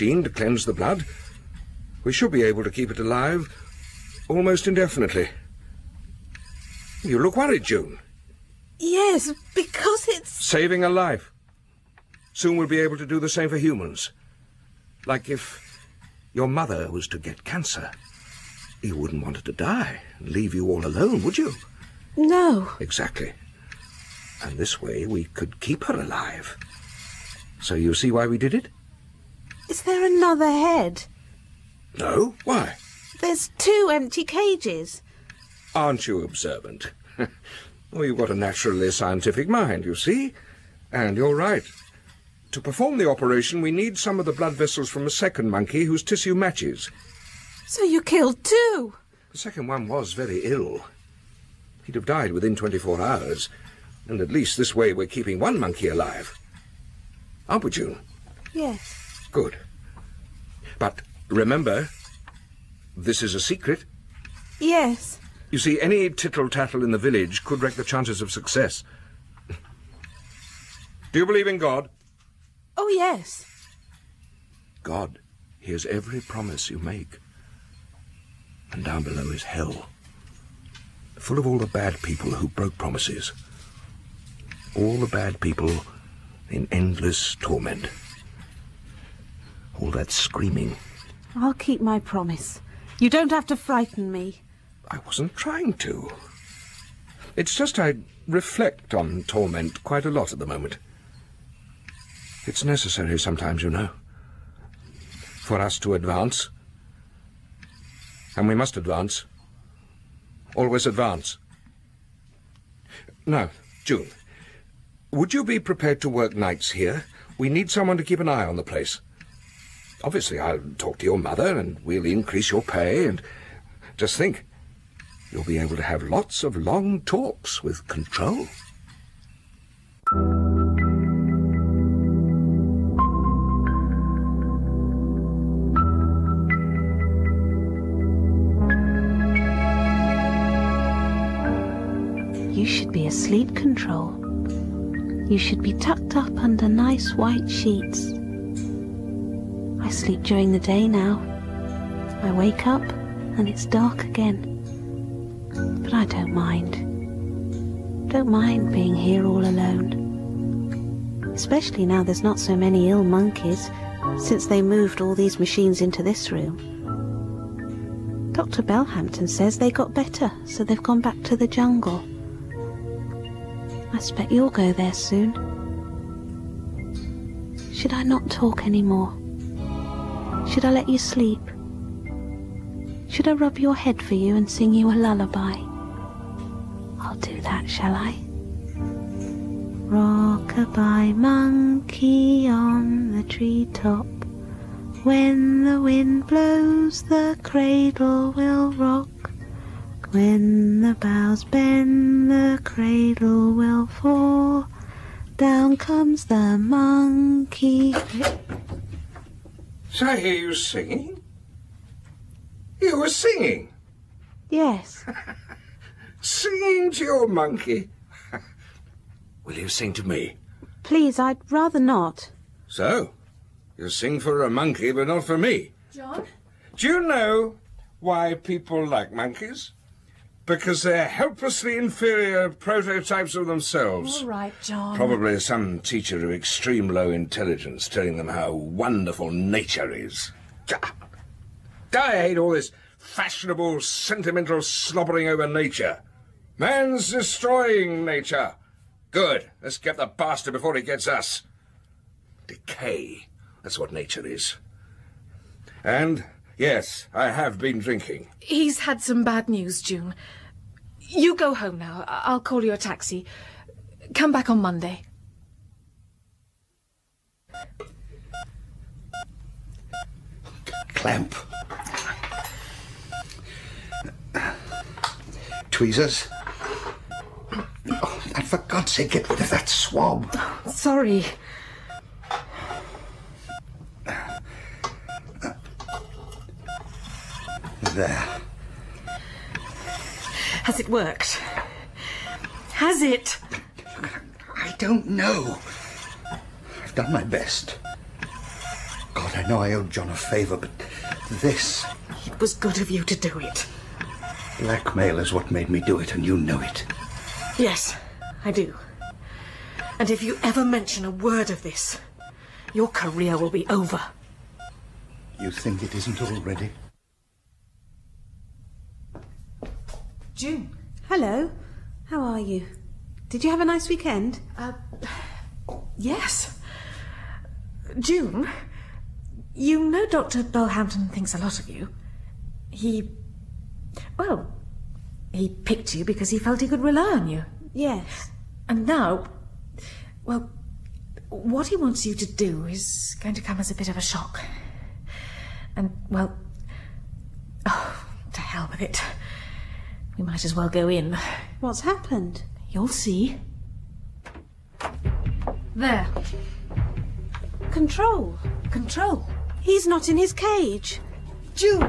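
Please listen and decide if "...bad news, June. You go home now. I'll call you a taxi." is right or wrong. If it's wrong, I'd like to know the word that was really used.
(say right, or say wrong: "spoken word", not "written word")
right.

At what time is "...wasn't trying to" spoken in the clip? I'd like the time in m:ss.
1:35.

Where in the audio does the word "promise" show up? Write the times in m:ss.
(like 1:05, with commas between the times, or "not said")
1:16, 1:22, 1:32.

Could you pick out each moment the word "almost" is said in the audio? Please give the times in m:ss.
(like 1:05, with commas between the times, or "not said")
0:04.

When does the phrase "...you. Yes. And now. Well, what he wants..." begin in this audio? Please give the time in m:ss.
5:37.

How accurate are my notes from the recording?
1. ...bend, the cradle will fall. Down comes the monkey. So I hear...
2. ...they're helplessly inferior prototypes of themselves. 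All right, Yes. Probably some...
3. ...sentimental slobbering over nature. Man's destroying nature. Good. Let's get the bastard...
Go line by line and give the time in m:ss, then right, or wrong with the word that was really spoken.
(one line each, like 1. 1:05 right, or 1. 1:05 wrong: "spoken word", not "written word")
1. 3:21 right
2. 3:50 wrong: "John", not "Yes"
3. 4:03 right.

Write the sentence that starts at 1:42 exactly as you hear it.
It's necessary sometimes, you know, for us to advance.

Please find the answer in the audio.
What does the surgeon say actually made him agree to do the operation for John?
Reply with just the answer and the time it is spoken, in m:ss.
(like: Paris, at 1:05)
blackmail, at 5:04.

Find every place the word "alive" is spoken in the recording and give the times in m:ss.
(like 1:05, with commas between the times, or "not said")
0:02, 0:25, 0:55.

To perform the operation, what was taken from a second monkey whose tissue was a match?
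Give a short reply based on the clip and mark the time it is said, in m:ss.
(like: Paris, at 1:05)
blood vessels, at 0:44.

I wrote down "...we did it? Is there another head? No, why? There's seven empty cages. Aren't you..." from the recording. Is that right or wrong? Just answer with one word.
wrong.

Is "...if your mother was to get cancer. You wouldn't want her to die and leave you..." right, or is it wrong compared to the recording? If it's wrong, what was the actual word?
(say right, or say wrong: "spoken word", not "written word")
right.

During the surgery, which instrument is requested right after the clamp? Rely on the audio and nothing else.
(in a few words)
tweezers.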